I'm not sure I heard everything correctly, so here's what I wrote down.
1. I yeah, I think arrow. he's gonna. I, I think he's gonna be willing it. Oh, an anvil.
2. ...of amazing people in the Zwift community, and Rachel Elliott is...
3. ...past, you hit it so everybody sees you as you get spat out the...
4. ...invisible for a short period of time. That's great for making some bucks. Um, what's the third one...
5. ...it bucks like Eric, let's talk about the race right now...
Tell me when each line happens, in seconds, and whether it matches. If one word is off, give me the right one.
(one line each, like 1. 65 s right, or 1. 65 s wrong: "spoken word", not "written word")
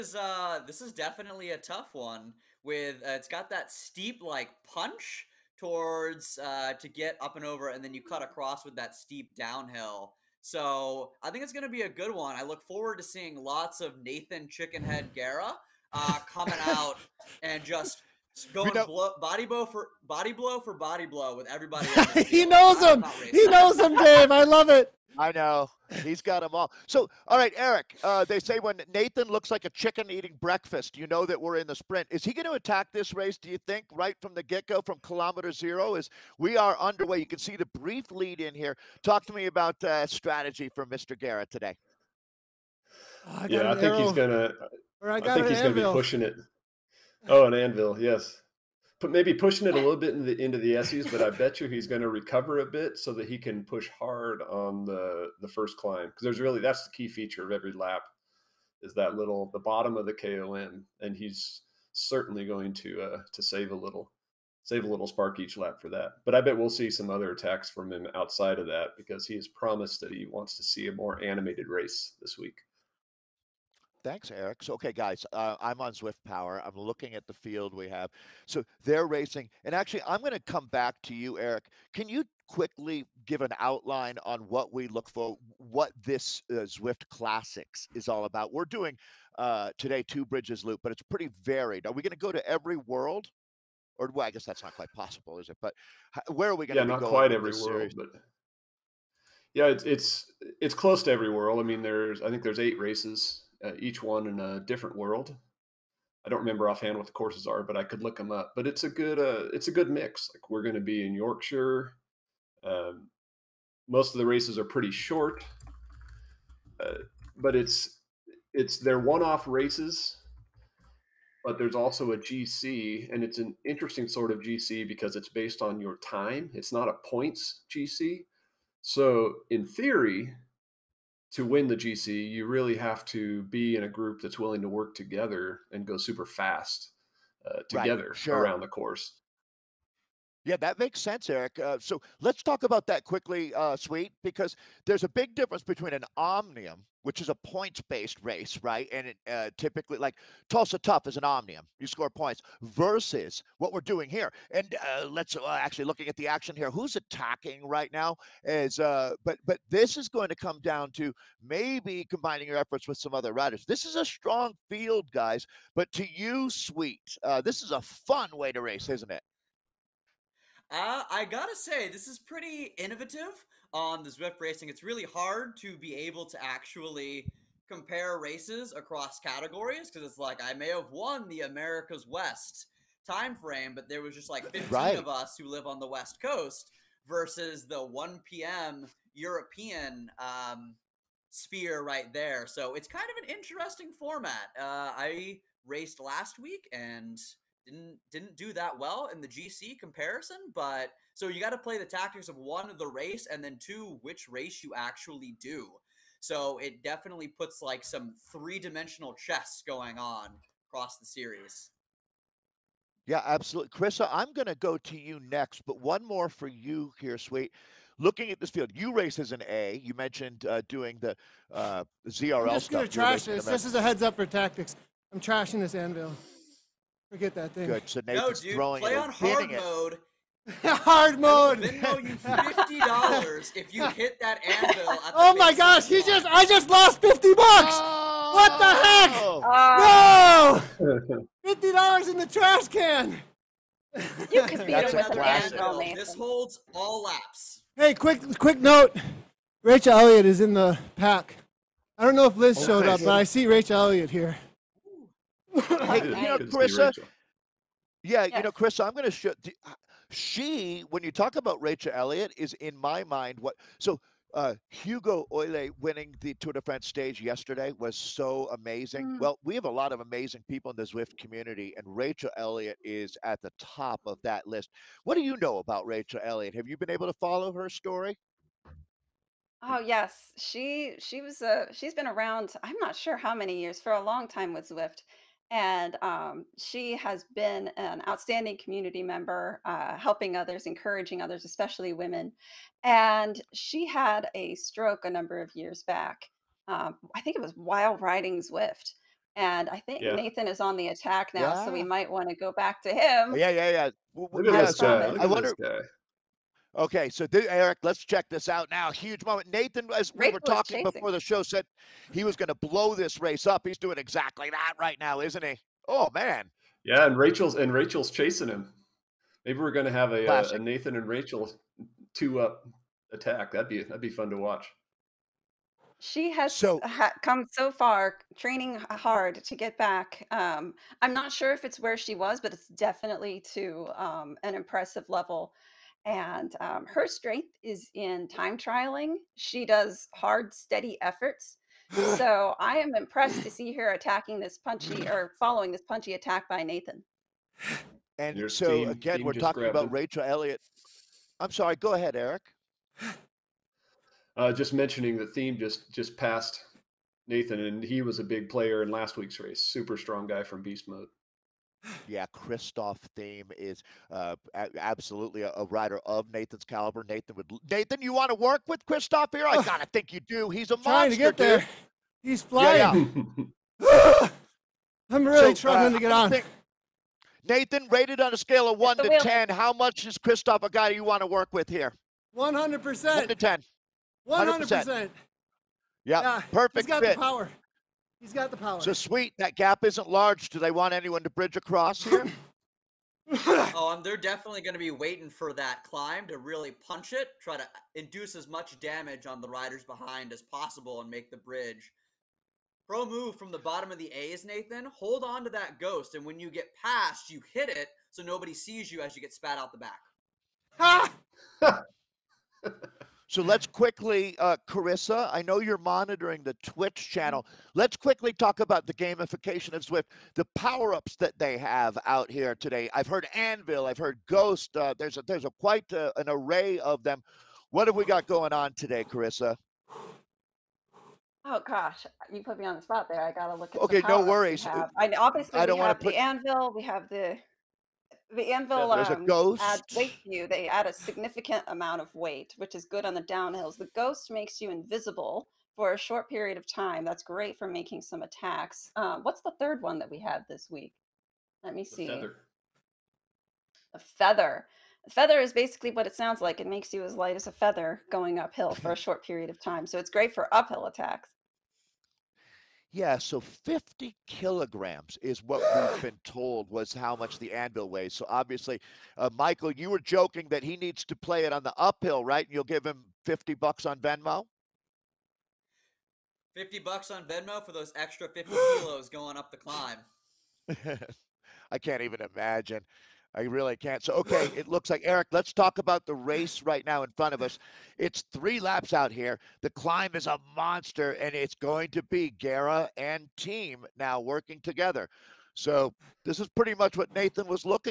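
1. 43 s wrong: "pushing", not "willing"
2. 269 s right
3. 406 s wrong: "nobody", not "everybody"
4. 444 s wrong: "attacks", not "bucks"
5. 484 s wrong: "looks", not "bucks".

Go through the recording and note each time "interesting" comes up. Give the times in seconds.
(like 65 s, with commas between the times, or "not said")
123 s, 193 s.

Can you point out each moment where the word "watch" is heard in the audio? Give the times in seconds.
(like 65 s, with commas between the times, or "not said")
324 s.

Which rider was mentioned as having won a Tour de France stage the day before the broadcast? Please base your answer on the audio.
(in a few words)
Hugo Houle.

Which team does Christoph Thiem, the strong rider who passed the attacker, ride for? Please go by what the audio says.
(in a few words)
Beast Mode.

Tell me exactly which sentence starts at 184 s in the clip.
of us who live on the West Coast versus the 1 p.m.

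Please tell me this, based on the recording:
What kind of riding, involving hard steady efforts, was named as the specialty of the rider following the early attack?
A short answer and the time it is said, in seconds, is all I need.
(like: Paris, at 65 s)
time trialing, at 338 s.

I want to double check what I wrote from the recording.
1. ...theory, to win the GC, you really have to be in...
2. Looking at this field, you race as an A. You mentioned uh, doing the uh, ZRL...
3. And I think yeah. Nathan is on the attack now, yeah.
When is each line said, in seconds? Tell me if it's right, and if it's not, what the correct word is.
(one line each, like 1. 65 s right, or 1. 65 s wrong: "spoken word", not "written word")
1. 129 s right
2. 217 s right
3. 299 s right.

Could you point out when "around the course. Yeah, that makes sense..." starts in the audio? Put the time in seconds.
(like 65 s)
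138 s.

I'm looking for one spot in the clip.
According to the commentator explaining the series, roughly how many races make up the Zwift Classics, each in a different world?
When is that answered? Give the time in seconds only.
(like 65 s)
102 s.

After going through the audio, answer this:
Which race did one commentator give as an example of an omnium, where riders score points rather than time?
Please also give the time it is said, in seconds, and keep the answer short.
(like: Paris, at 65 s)
Tulsa Tough, at 150 s.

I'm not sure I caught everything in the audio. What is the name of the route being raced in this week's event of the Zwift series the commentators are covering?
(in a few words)
Two Bridges Loop.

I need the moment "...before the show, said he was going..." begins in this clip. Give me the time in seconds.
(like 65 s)
310 s.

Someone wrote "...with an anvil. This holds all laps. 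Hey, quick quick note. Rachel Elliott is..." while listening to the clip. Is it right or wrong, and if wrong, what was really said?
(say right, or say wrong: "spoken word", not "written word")
right.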